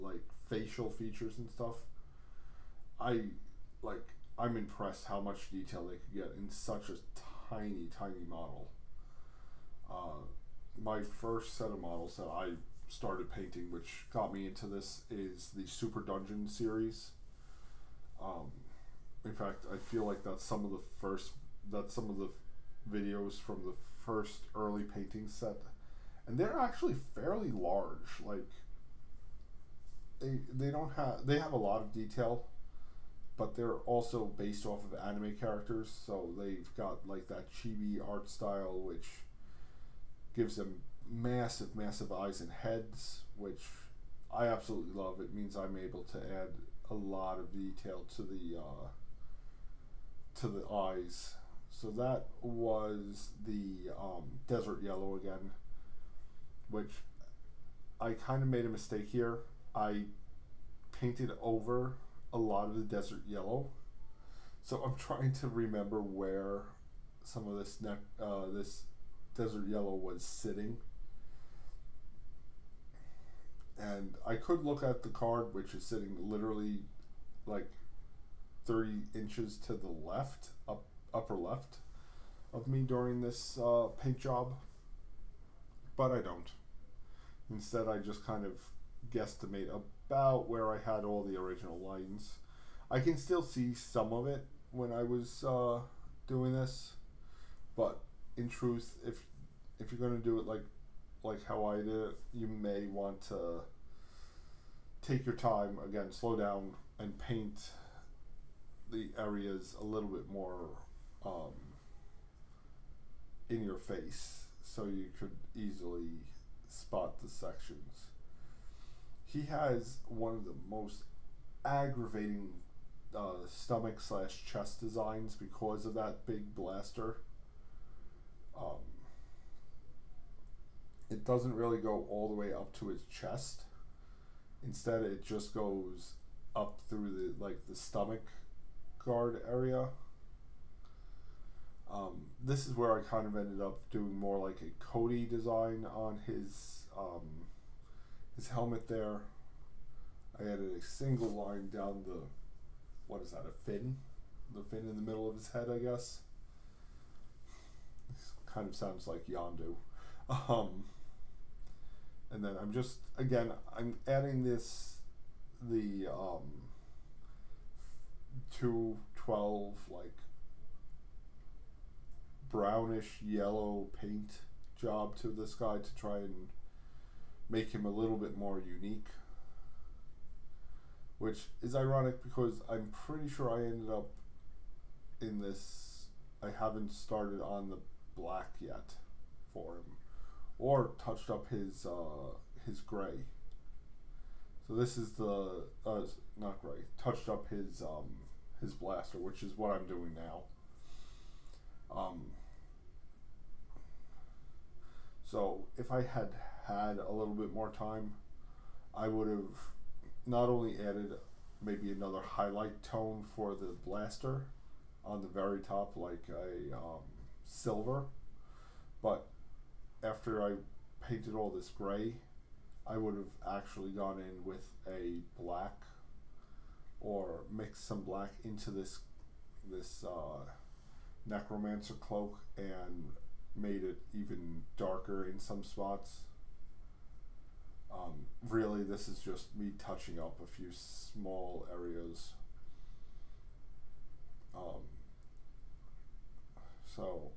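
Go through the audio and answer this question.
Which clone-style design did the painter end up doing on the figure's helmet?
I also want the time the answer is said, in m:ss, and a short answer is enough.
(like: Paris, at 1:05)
Cody, at 2:24.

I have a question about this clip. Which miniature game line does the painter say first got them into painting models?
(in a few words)
Super Dungeon.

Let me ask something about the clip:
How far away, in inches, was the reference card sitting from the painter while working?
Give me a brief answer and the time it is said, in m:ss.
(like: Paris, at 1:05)
30 inches, at 1:18.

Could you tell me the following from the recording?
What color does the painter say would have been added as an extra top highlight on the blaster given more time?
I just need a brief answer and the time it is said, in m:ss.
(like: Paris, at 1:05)
silver, at 3:37.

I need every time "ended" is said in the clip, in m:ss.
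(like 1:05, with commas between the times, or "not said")
2:23, 3:03.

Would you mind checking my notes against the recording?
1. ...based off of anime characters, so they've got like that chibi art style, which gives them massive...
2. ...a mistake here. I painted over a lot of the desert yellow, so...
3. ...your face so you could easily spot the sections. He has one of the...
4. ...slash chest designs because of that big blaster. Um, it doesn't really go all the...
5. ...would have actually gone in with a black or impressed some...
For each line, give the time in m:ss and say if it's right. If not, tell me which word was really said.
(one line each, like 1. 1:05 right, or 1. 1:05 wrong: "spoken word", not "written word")
1. 0:34 right
2. 0:58 right
3. 1:53 right
4. 2:04 right
5. 3:42 wrong: "mixed", not "impressed".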